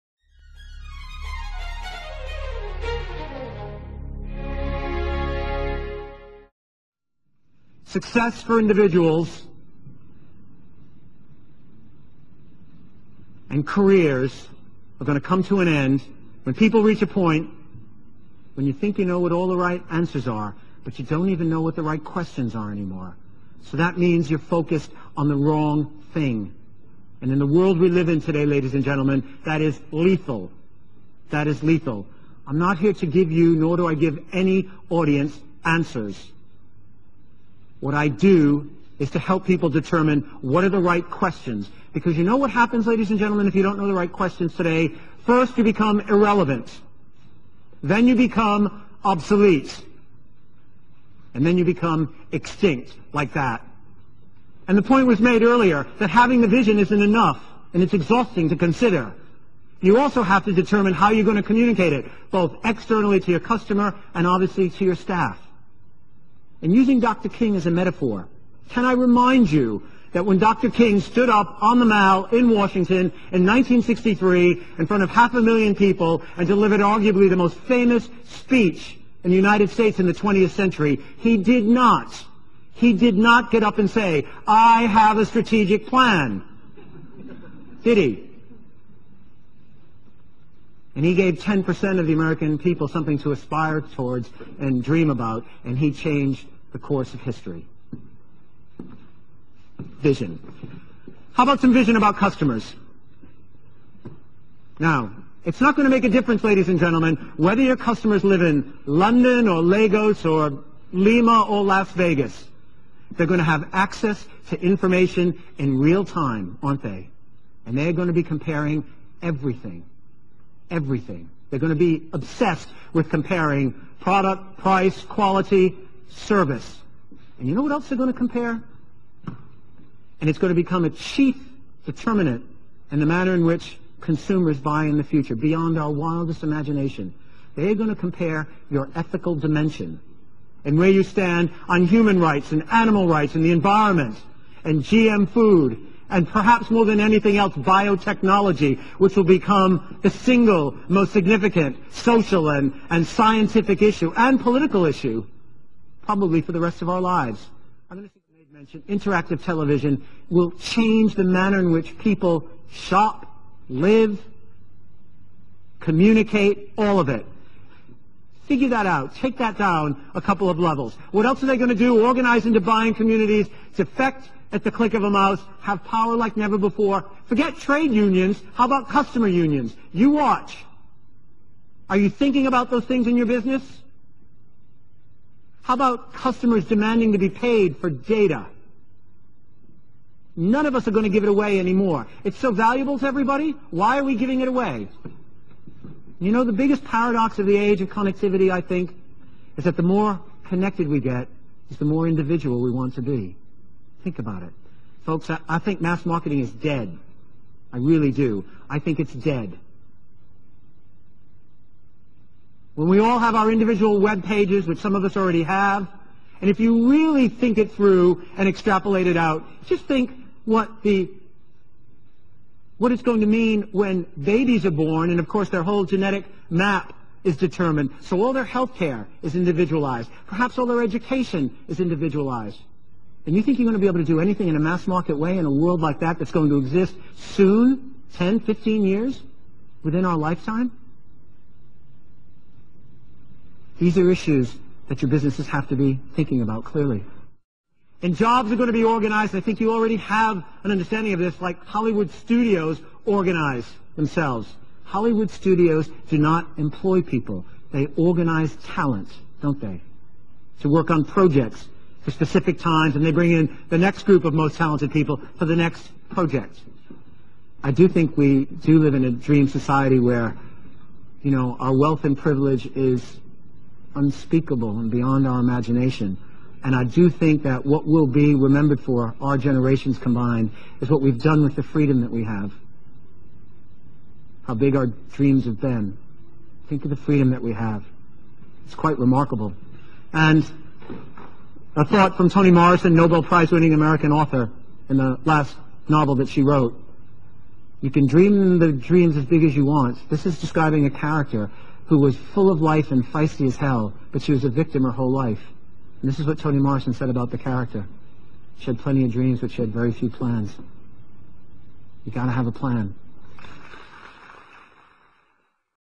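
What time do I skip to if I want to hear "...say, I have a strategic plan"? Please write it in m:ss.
1:23.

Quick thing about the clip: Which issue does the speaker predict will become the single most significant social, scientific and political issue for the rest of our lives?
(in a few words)
biotechnology.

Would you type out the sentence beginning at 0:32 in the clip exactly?
I'm not here to give you, nor do I give any audience answers.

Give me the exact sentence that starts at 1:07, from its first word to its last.
King as a metaphor, can I remind you that when Dr.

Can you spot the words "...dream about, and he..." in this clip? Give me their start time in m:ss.
1:34.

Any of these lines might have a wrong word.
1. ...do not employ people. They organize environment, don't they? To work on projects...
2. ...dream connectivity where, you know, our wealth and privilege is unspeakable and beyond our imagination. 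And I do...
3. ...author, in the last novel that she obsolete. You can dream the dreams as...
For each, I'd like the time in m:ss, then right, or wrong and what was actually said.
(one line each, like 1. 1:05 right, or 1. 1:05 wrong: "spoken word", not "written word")
1. 4:16 wrong: "talent", not "environment"
2. 4:29 wrong: "society", not "connectivity"
3. 4:54 wrong: "wrote", not "obsolete".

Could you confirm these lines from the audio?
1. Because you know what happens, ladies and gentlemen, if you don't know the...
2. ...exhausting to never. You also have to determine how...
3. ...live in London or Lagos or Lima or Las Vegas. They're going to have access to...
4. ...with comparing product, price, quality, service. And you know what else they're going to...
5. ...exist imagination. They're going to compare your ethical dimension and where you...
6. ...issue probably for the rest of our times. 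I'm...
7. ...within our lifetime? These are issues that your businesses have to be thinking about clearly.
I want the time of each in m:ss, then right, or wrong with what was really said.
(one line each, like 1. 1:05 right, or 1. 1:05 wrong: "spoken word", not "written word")
1. 0:41 right
2. 0:57 wrong: "consider", not "never"
3. 1:48 right
4. 2:02 right
5. 2:15 wrong: "wildest", not "exist"
6. 2:34 wrong: "lives", not "times"
7. 3:59 right.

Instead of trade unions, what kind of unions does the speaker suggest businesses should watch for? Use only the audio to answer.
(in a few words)
customer unions.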